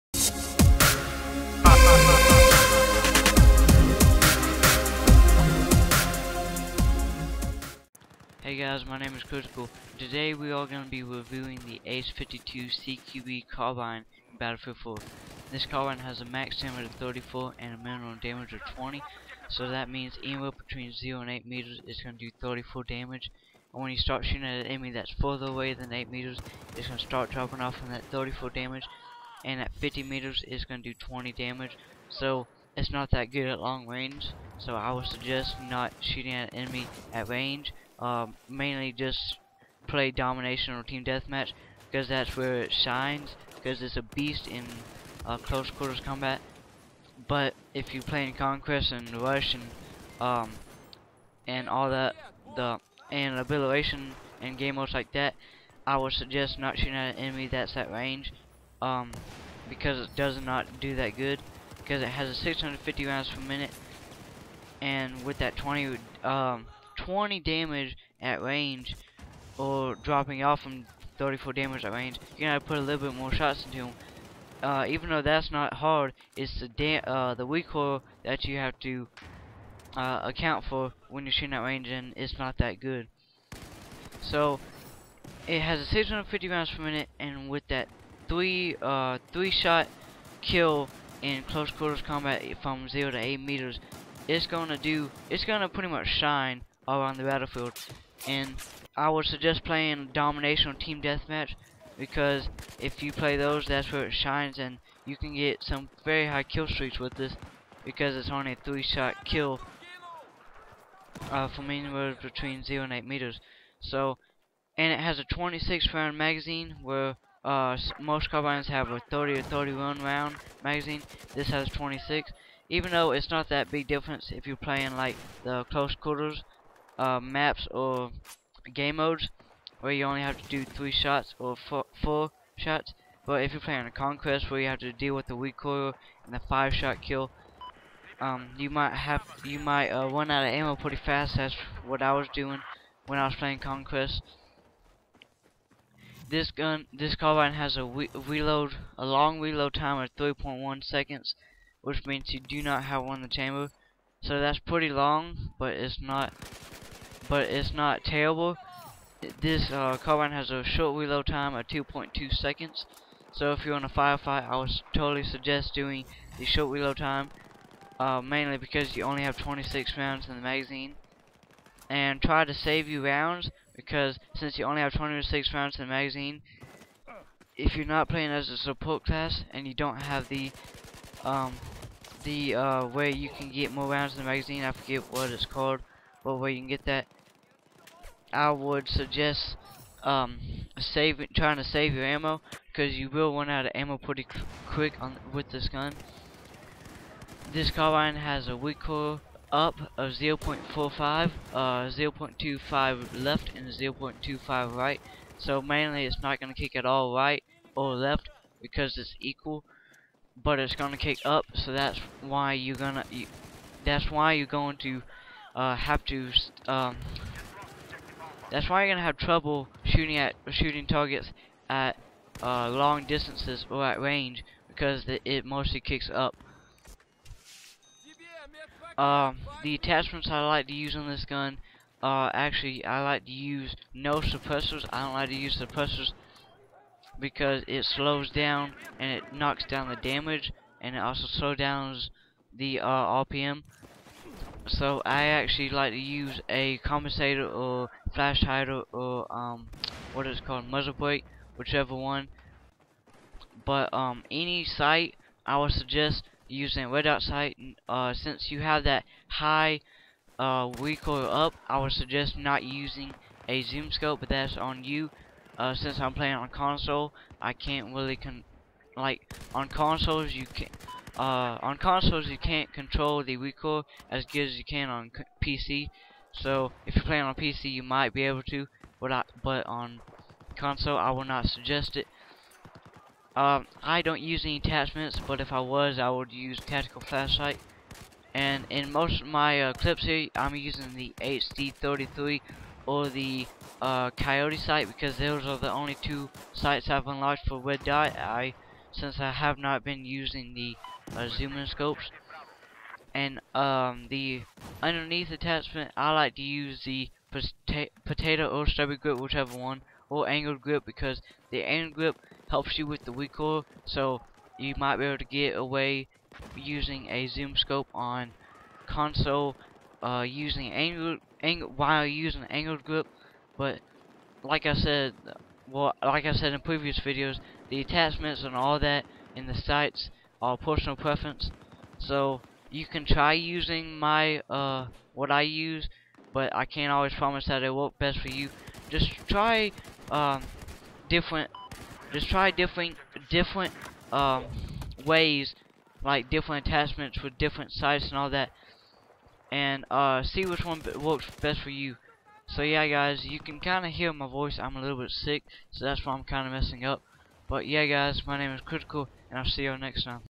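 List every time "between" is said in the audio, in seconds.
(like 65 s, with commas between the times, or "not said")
20 s, 112 s.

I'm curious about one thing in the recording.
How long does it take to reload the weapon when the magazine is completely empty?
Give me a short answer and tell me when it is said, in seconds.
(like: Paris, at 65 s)
3.1 seconds, at 150 s.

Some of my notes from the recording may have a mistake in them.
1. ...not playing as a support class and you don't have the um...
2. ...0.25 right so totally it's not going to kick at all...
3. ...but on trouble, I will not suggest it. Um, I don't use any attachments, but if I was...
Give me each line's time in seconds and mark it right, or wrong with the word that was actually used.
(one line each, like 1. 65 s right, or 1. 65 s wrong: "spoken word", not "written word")
1. 177 s right
2. 203 s wrong: "mainly", not "totally"
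3. 279 s wrong: "console", not "trouble".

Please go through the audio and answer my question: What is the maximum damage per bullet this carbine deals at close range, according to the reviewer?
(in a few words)
34.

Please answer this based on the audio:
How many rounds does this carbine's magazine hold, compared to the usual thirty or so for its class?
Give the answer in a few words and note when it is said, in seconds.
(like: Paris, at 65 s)
26, at 115 s.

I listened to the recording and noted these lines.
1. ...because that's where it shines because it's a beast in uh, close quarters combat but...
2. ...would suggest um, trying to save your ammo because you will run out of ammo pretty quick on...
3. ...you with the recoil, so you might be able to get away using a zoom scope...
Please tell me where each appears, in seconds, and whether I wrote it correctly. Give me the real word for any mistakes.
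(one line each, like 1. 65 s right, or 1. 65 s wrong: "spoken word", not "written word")
1. 41 s right
2. 188 s right
3. 312 s right.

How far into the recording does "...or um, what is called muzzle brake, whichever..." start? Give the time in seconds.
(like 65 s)
248 s.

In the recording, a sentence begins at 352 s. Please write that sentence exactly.
So yeah, guys, you can kind of hear my voice.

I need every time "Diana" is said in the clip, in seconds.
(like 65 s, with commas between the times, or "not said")
not said.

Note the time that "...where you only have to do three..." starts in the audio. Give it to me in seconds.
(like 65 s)
129 s.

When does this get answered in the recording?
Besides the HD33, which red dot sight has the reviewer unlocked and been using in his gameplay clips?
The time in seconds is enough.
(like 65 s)
294 s.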